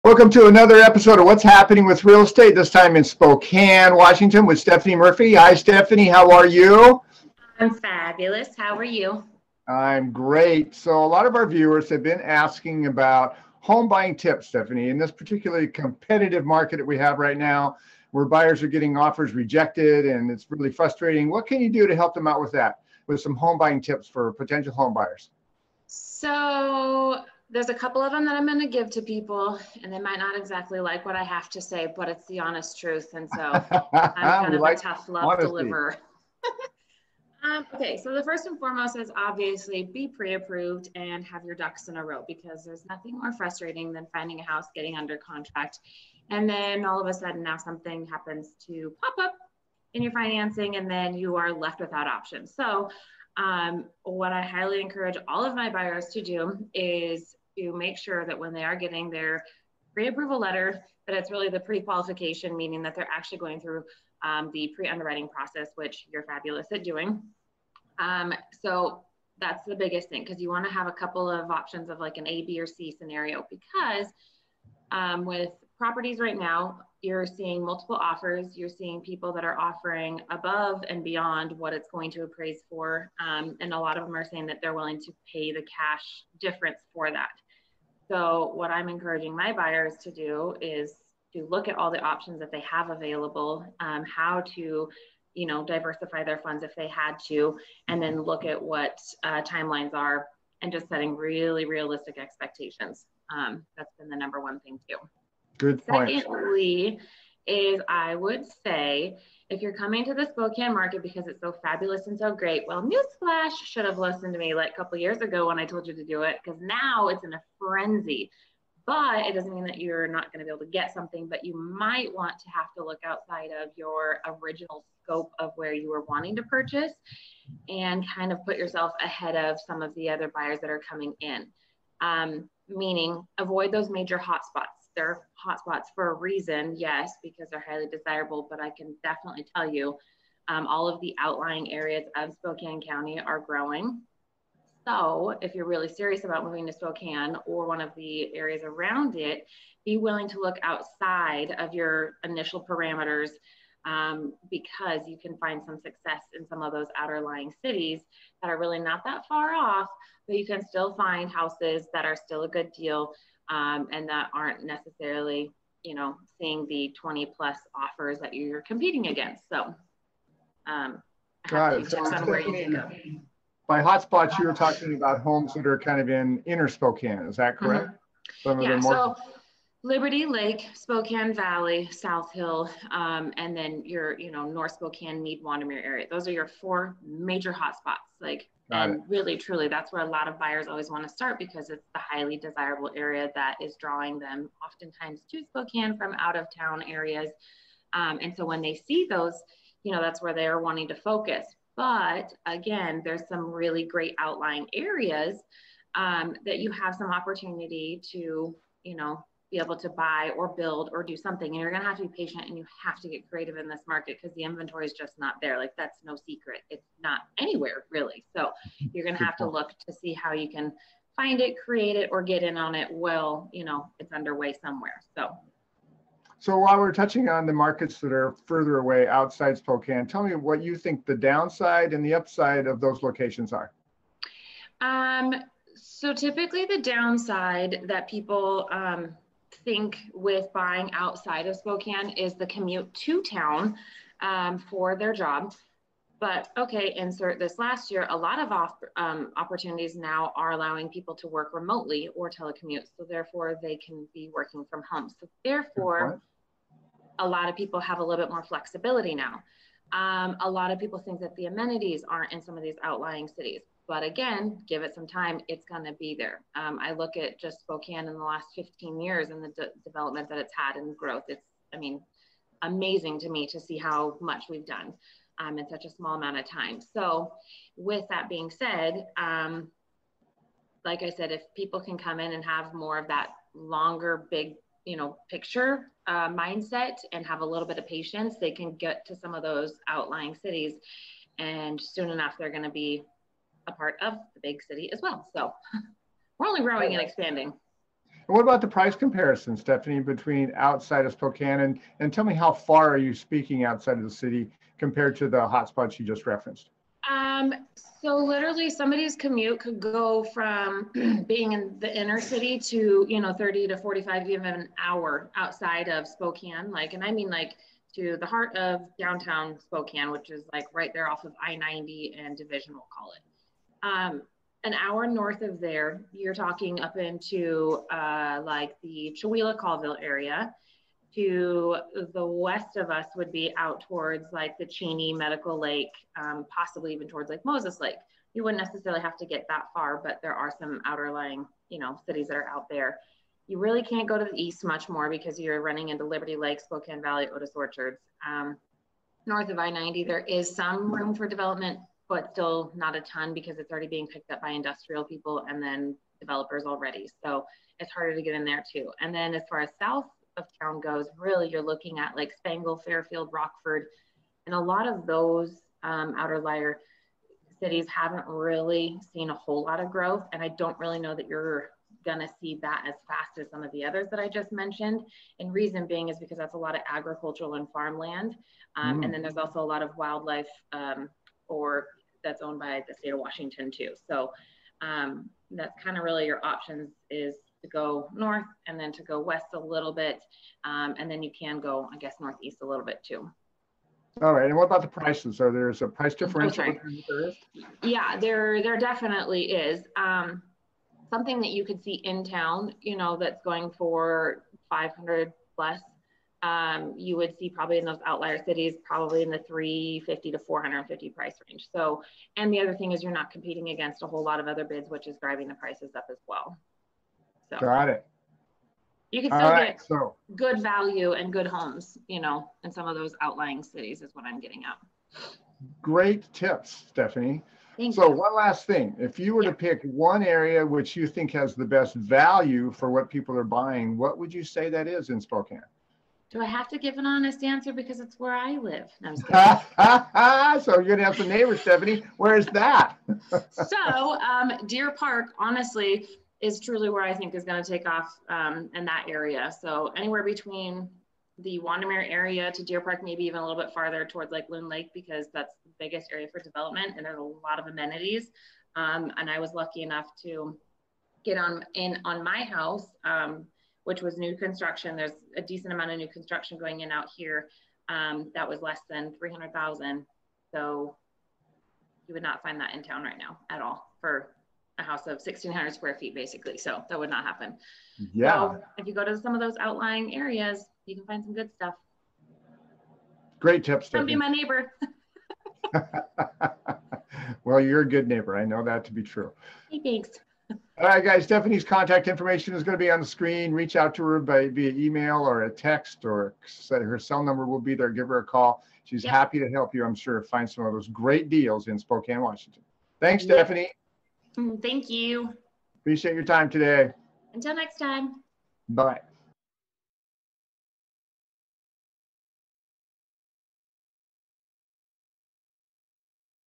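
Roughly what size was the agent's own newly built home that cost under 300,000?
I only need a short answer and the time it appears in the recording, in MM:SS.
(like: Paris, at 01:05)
1,600 square feet, at 07:55.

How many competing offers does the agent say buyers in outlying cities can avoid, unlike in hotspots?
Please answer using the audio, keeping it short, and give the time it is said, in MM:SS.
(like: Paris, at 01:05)
20 plus, at 02:46.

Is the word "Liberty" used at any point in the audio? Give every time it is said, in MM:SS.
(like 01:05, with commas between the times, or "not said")
02:59, 05:46.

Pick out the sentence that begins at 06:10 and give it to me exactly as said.
And I don't really know that you're gonna see that as fast as some of the others that I just mentioned.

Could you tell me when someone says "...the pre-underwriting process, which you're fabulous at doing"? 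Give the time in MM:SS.
01:04.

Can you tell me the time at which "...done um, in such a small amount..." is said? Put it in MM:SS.
04:34.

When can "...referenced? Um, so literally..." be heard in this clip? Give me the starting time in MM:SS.
05:06.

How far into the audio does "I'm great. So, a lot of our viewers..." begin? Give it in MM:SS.
00:09.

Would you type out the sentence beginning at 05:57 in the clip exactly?
So it's harder to get in there too.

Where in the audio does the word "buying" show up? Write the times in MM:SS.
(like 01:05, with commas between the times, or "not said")
00:13, 00:23, 04:00, 07:13.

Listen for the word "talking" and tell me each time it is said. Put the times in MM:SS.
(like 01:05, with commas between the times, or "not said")
02:54, 05:26.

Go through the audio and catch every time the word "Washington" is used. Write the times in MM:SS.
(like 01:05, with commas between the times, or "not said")
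00:03, 06:23, 08:22.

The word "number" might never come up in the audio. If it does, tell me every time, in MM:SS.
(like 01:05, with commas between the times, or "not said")
01:44, 08:17.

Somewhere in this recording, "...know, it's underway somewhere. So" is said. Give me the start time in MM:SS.
03:43.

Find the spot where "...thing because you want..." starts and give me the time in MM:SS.
01:10.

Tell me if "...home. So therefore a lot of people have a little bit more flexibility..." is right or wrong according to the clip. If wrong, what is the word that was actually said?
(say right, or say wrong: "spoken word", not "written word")
right.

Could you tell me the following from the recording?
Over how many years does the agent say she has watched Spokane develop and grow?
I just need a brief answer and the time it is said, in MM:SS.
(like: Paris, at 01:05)
15 years, at 04:28.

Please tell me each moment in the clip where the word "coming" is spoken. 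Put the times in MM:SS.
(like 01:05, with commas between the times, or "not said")
01:49, 02:10.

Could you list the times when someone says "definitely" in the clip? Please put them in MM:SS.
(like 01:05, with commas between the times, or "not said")
02:19, 06:38.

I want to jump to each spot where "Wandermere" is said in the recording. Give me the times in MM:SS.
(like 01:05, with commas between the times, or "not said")
03:05, 07:31.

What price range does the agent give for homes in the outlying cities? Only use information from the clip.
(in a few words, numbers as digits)
350 to 450.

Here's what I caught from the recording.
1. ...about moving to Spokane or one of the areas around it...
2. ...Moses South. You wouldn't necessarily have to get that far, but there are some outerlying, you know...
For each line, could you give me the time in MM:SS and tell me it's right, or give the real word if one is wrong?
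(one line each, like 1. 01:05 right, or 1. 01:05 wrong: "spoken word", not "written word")
1. 02:26 right
2. 05:37 wrong: "Lake", not "South".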